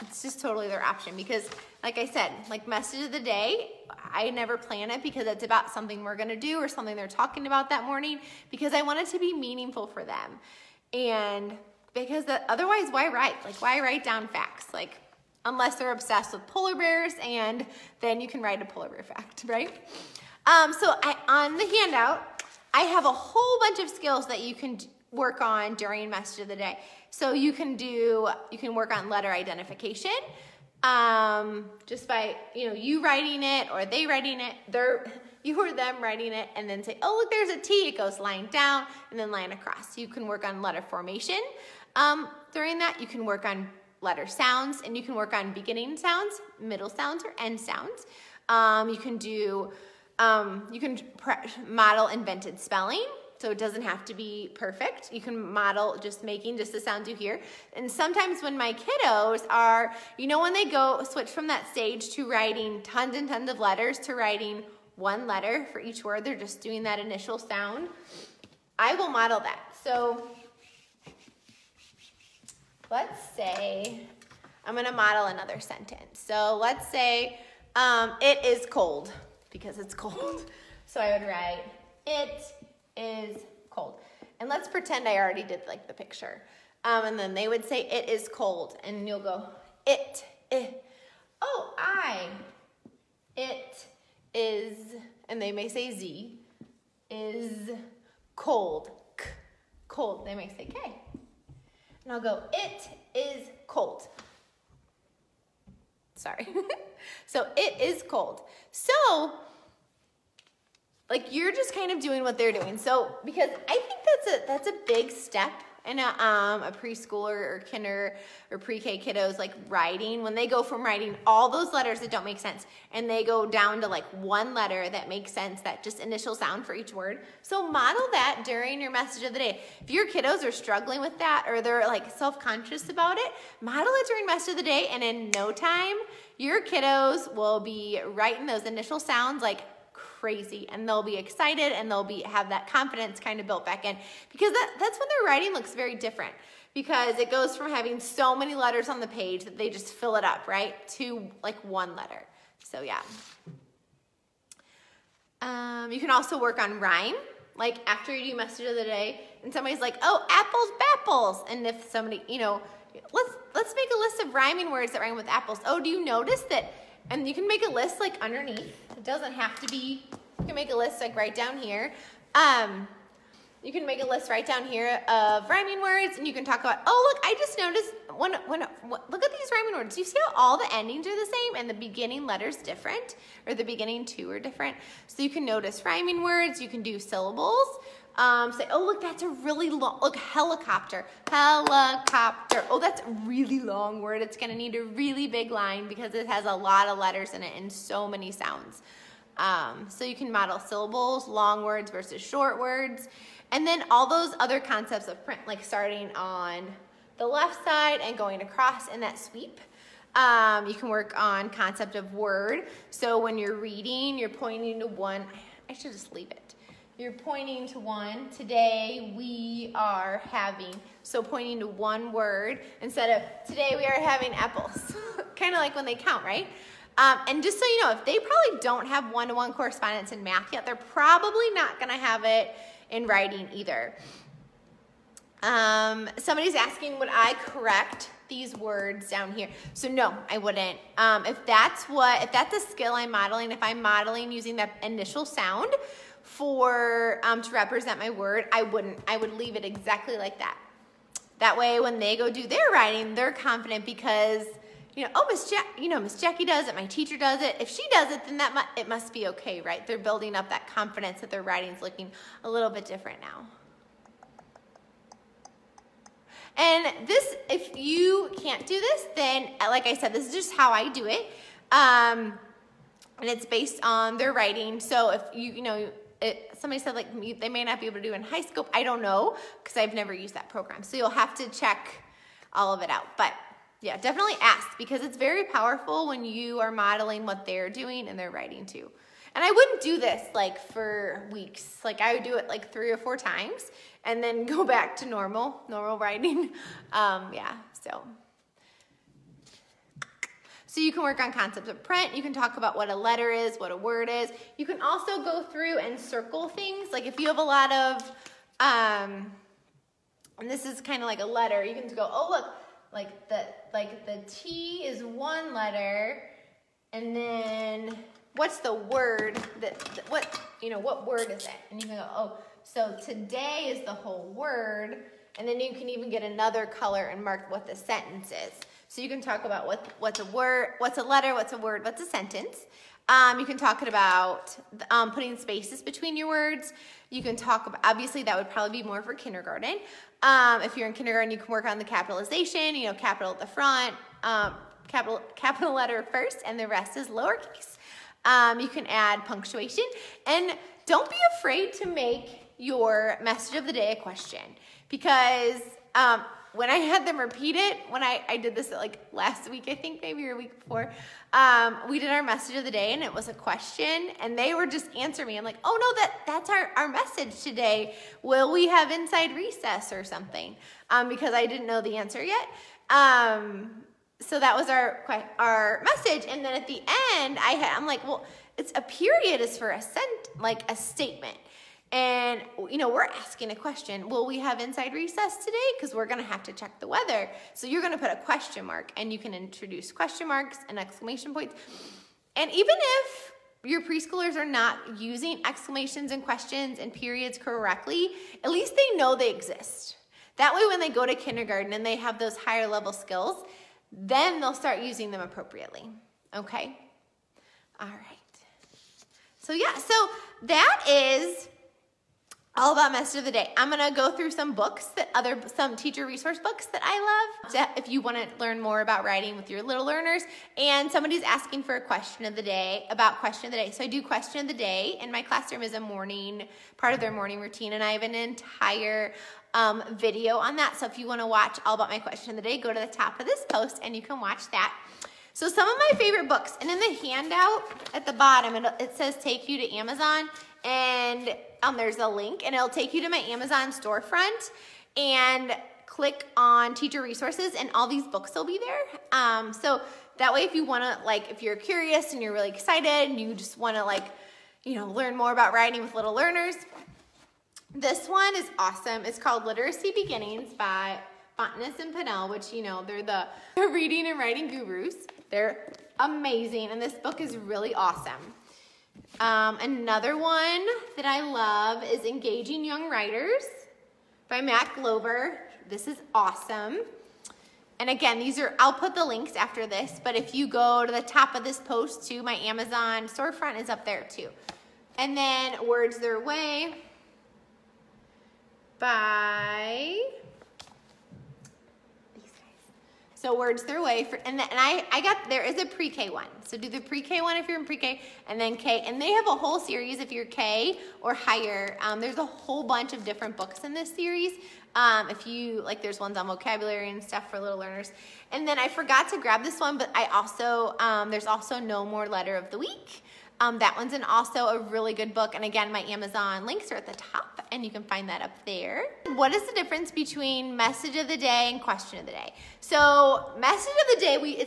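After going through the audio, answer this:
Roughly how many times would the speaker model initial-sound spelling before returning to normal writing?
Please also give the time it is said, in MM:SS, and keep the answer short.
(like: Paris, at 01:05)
3 or 4 times, at 04:52.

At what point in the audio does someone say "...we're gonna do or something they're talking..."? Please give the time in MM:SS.
00:06.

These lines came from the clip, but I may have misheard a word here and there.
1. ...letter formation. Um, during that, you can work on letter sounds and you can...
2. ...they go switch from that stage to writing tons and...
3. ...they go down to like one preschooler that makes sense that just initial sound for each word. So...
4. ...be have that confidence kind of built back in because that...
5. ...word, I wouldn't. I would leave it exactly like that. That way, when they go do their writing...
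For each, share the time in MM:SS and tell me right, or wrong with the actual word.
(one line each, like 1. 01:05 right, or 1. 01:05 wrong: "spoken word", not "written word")
1. 00:40 right
2. 01:00 right
3. 02:03 wrong: "letter", not "preschooler"
4. 02:22 right
5. 04:08 right.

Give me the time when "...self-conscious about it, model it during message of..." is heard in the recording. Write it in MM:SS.
02:12.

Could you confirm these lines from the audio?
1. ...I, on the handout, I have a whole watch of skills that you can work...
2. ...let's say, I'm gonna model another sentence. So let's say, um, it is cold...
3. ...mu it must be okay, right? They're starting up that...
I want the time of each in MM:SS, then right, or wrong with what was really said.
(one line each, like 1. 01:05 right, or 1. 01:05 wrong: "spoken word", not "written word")
1. 00:21 wrong: "bunch", not "watch"
2. 01:12 right
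3. 04:18 wrong: "building", not "starting".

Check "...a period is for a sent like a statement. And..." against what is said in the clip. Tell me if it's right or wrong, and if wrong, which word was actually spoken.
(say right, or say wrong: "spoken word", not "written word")
right.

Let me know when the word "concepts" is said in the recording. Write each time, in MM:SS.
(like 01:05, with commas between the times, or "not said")
03:24, 03:31, 05:01.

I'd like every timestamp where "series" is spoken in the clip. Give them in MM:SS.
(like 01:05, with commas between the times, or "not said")
08:19, 08:23.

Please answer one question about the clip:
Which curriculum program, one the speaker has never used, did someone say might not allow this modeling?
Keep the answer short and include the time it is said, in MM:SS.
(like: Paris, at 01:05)
HighScope, at 04:38.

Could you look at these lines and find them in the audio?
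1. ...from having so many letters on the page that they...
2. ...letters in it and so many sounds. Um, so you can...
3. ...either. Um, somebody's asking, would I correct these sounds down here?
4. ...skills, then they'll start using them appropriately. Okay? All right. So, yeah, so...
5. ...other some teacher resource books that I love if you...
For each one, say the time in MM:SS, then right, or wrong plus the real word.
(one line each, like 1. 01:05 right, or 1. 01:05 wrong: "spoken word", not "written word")
1. 02:27 right
2. 03:16 right
3. 03:53 wrong: "words", not "sounds"
4. 06:42 right
5. 06:55 right.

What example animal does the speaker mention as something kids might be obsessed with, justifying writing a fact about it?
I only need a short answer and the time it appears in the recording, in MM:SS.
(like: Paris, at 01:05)
Polar bears, at 00:16.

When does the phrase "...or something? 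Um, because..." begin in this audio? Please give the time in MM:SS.
06:09.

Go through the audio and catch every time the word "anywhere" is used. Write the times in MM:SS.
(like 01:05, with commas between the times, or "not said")
not said.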